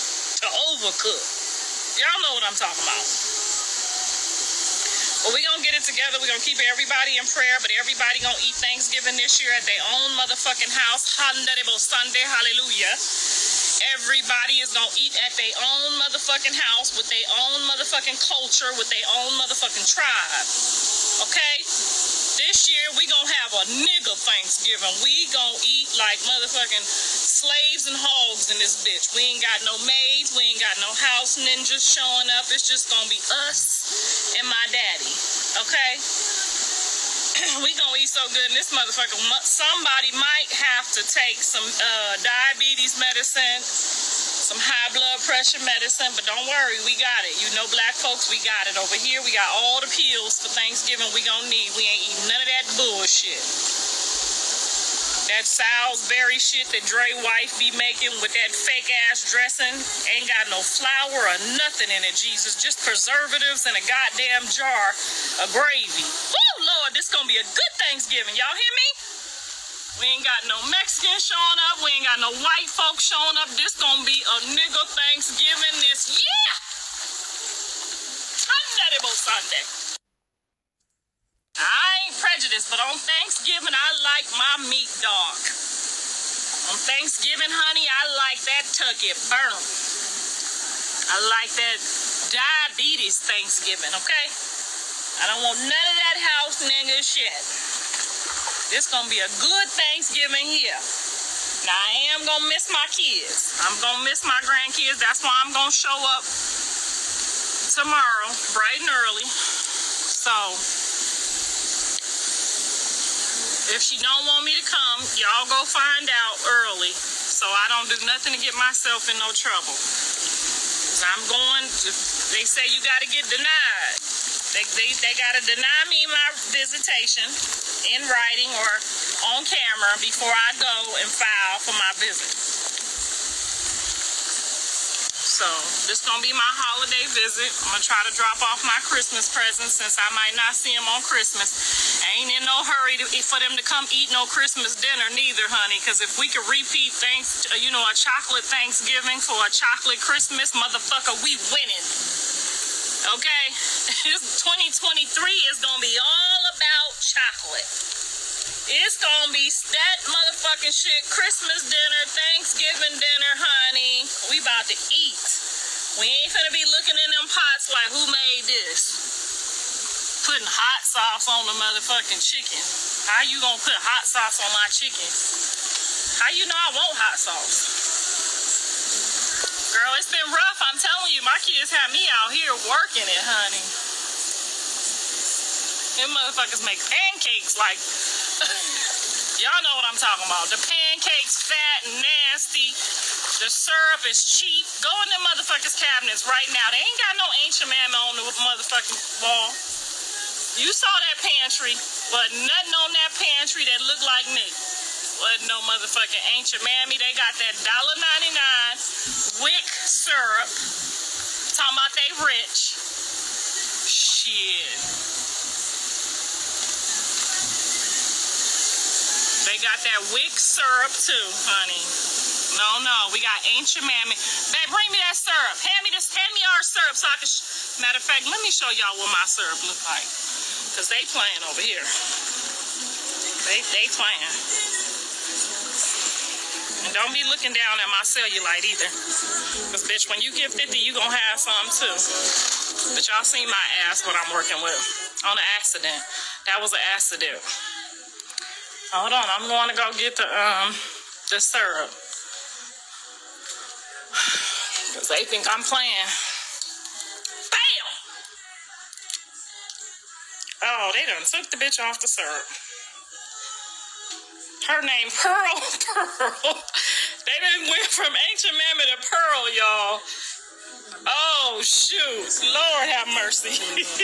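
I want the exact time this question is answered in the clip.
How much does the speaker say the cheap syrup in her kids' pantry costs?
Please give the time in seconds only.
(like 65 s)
207 s.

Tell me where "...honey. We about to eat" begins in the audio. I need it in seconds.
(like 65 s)
163 s.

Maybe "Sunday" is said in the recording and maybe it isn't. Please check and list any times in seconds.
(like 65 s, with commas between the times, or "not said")
11 s, 79 s.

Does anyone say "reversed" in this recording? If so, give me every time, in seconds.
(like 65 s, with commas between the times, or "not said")
not said.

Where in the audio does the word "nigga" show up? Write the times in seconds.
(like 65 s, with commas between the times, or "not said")
23 s, 74 s, 96 s.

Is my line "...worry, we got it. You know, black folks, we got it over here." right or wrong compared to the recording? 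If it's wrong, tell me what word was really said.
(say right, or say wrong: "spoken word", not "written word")
right.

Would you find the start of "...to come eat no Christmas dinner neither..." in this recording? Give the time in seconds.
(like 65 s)
143 s.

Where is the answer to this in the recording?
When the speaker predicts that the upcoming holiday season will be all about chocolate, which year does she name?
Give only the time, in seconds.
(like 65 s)
153 s.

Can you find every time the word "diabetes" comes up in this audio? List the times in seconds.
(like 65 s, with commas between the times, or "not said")
42 s, 92 s.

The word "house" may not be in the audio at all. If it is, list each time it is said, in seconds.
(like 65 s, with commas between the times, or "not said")
10 s, 16 s, 30 s, 96 s.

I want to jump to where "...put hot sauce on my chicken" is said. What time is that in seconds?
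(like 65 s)
173 s.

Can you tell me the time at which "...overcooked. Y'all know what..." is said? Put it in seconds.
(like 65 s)
0 s.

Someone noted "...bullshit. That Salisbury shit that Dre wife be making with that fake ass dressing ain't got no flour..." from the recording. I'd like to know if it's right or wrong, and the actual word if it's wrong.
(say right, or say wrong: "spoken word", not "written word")
right.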